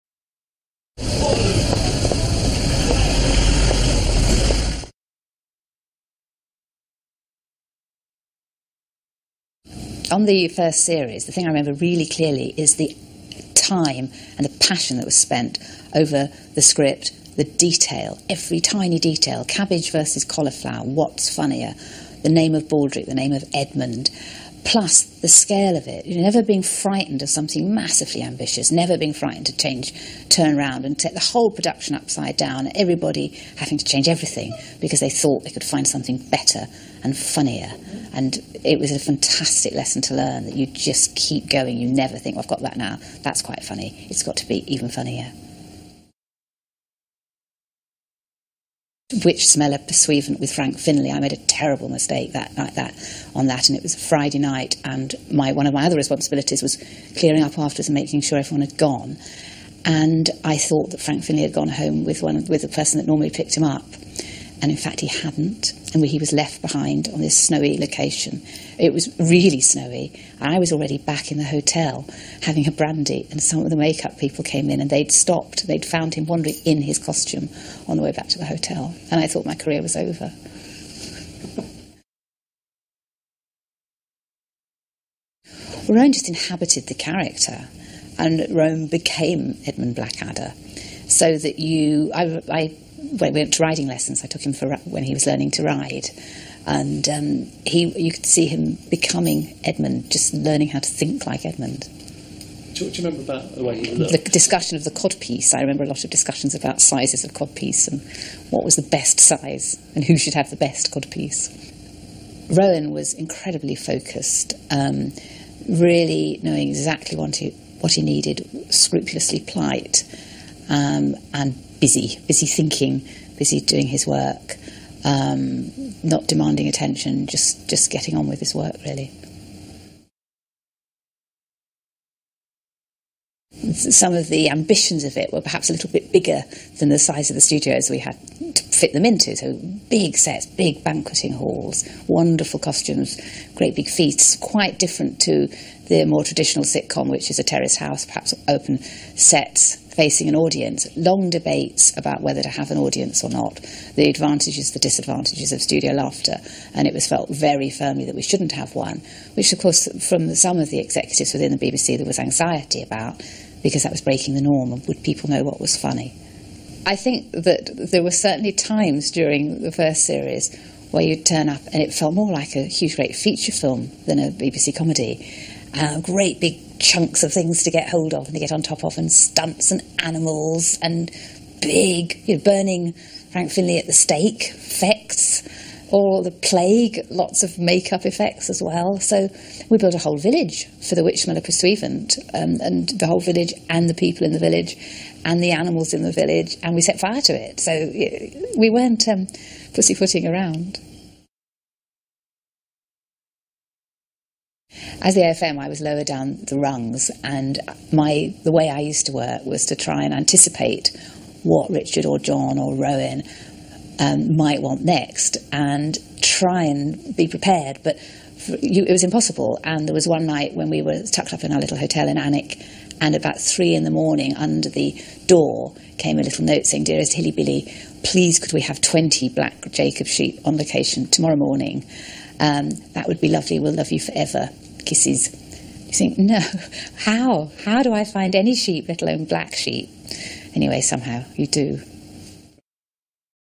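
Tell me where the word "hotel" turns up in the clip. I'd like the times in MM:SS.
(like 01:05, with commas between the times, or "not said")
01:11, 01:18, 03:41.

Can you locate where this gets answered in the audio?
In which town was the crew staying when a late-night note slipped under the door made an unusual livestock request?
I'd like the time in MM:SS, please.
03:42.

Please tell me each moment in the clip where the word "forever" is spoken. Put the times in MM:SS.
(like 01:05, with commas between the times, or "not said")
03:53.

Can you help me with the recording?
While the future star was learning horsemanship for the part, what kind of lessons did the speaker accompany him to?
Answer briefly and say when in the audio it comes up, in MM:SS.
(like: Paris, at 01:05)
Riding lessons, at 01:33.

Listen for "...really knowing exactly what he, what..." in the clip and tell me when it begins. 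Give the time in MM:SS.
01:55.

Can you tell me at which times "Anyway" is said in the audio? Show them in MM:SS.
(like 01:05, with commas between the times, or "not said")
04:00.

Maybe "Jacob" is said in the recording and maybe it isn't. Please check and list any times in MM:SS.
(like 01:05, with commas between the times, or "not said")
03:49.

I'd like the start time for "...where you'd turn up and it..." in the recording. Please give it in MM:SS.
02:50.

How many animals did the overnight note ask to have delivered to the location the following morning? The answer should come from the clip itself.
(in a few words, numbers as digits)
20.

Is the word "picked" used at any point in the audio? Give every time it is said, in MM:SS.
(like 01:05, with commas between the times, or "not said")
01:03.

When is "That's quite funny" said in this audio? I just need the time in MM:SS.
00:43.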